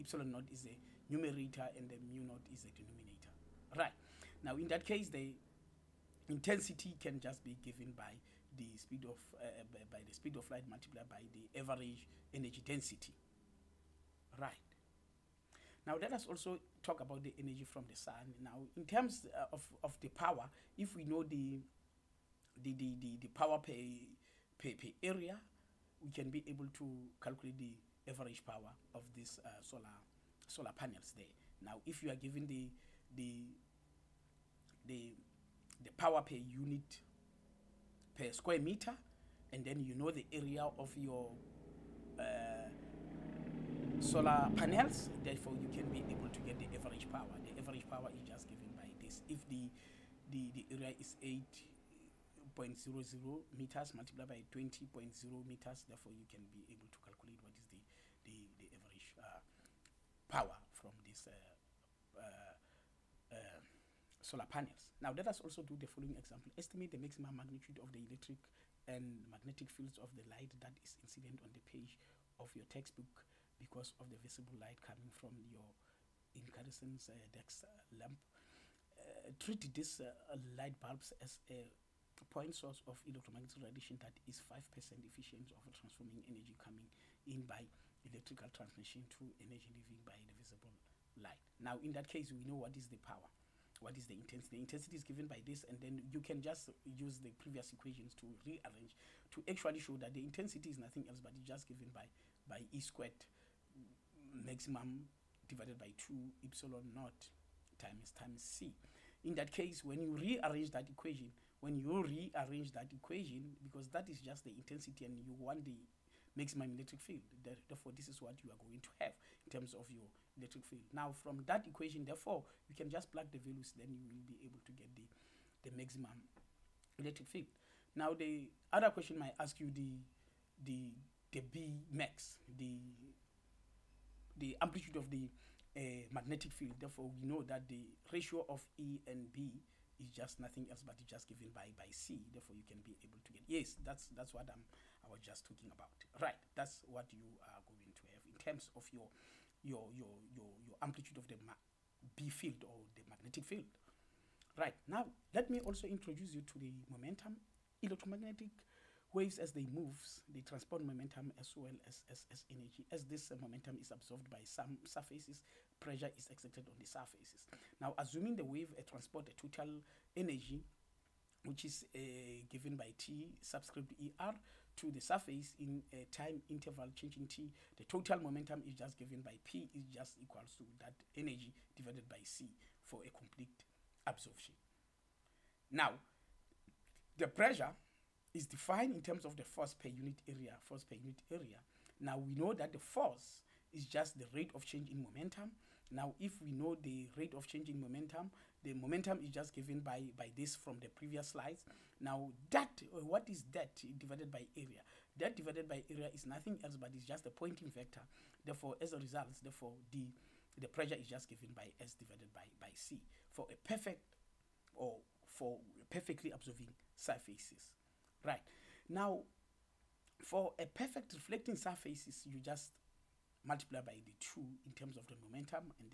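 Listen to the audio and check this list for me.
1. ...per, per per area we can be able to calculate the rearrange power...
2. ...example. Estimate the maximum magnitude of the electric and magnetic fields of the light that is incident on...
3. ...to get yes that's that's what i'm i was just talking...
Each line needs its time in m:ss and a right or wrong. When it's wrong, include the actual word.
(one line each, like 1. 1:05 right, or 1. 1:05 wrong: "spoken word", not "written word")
1. 0:23 wrong: "average", not "rearrange"
2. 1:06 right
3. 2:23 right.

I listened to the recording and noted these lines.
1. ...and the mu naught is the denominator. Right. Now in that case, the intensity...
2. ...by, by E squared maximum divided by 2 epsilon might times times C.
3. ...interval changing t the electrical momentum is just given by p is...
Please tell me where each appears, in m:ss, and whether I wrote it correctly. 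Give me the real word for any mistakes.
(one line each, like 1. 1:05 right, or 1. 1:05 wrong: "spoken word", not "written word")
1. 0:01 right
2. 1:41 wrong: "naught", not "might"
3. 2:56 wrong: "total", not "electrical".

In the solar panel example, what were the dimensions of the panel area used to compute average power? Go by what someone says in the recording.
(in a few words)
8.00 m by 20.0 m.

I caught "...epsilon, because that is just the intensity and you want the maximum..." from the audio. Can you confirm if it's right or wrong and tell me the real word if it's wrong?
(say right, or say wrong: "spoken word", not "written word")
wrong: "equation", not "epsilon".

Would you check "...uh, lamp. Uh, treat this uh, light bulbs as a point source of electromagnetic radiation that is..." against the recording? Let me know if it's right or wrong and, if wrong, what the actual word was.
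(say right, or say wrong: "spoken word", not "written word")
right.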